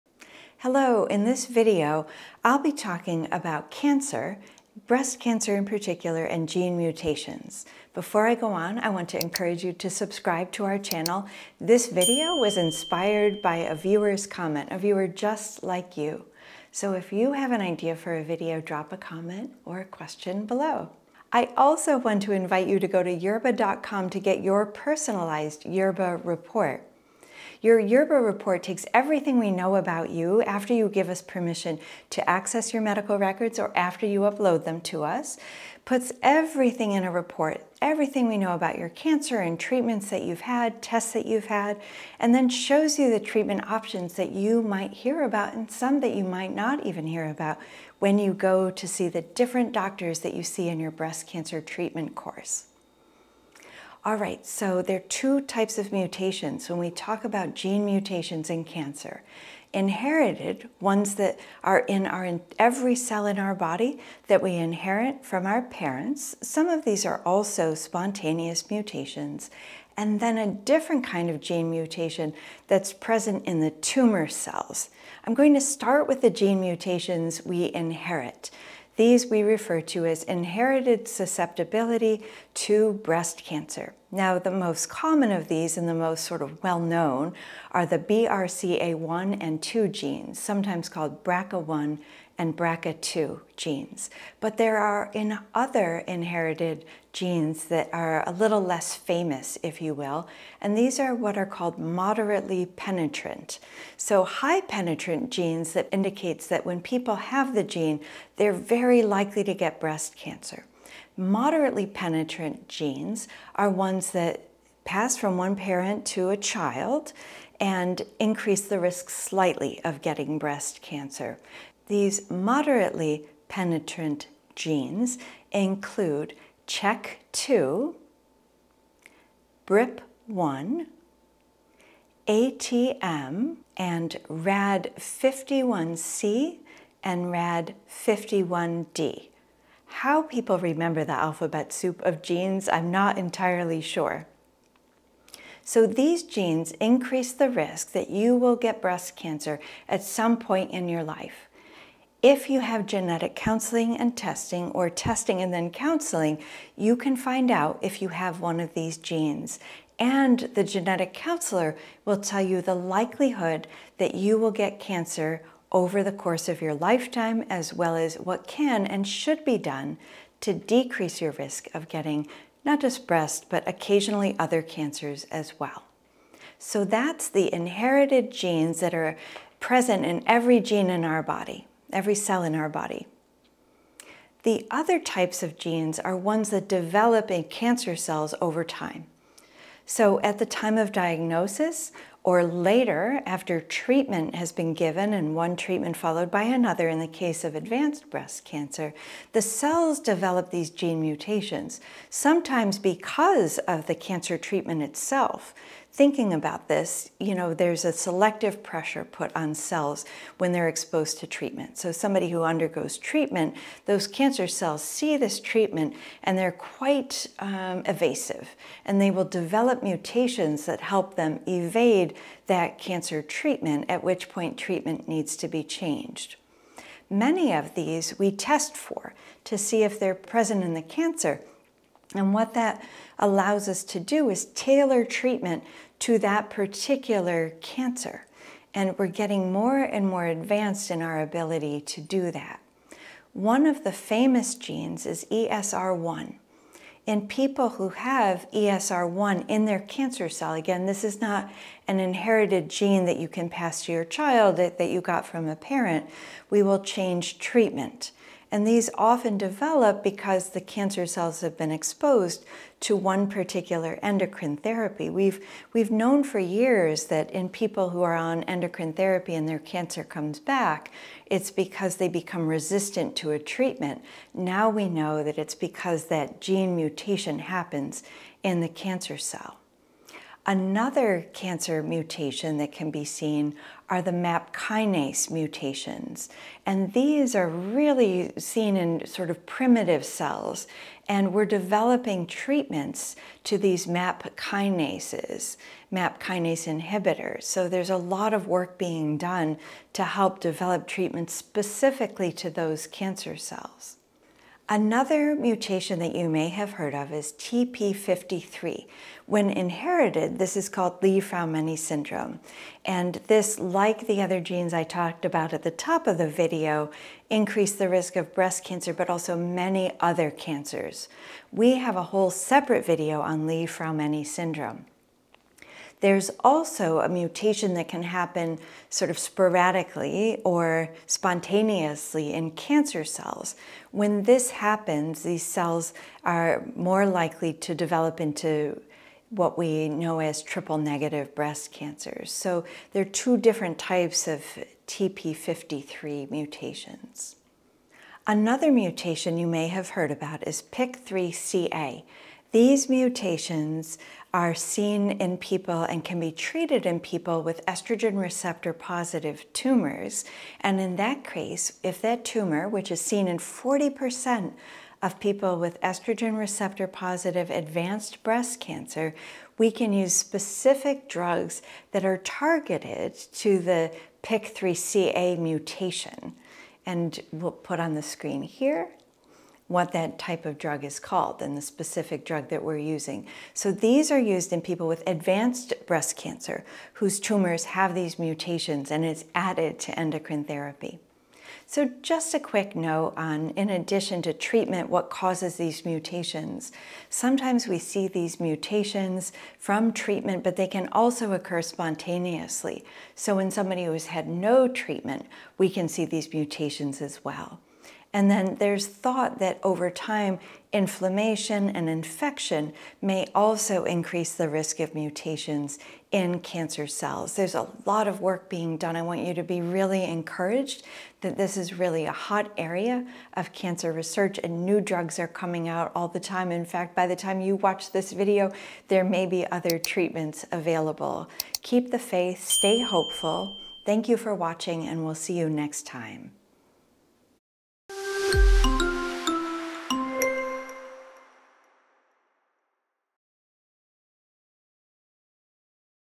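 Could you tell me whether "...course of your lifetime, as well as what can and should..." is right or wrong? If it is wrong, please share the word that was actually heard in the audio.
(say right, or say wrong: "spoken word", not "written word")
right.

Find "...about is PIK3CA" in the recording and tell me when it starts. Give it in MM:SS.
05:50.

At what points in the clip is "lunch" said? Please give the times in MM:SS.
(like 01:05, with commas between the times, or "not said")
not said.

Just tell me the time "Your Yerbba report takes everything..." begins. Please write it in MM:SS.
00:27.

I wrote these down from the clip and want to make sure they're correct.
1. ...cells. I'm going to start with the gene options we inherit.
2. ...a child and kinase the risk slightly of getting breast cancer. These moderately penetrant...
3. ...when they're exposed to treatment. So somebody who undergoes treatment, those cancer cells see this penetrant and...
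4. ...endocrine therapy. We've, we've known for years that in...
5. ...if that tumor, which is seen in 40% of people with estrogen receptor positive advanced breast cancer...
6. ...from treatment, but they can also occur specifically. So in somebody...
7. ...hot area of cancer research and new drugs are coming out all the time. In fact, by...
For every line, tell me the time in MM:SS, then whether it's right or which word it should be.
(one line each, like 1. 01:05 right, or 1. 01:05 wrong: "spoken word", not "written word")
1. 01:14 wrong: "mutations", not "options"
2. 01:56 wrong: "increase", not "kinase"
3. 03:30 wrong: "treatment", not "penetrant"
4. 04:24 right
5. 06:01 right
6. 06:39 wrong: "spontaneously", not "specifically"
7. 07:02 right.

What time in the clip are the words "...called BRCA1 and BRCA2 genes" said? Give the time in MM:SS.
01:30.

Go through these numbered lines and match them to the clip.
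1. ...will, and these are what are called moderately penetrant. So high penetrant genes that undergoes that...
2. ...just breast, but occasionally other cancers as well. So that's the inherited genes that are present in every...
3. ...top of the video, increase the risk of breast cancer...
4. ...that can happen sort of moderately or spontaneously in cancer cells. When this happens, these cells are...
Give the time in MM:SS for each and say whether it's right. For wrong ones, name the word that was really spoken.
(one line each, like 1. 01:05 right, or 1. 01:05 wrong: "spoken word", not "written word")
1. 01:39 wrong: "indicates", not "undergoes"
2. 02:52 right
3. 05:15 right
4. 05:27 wrong: "sporadically", not "moderately".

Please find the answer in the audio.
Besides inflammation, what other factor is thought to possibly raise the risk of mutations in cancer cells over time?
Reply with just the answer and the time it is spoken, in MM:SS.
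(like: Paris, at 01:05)
Infection, at 06:51.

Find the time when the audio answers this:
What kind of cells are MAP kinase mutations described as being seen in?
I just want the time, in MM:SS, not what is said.
04:49.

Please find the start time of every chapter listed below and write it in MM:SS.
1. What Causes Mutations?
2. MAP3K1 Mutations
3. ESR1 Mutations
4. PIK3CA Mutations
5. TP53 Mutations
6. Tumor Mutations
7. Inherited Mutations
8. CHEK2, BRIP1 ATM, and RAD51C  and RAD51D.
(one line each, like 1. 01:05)
1. 06:31
2. 04:41
3. 04:03
4. 05:43
5. 05:04
6. 03:04
7. 00:53
8. 02:02.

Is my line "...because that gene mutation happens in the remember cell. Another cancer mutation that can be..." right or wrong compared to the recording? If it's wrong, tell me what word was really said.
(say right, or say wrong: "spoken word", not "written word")
wrong: "cancer", not "remember".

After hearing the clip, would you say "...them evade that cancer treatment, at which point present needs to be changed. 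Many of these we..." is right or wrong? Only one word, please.
wrong.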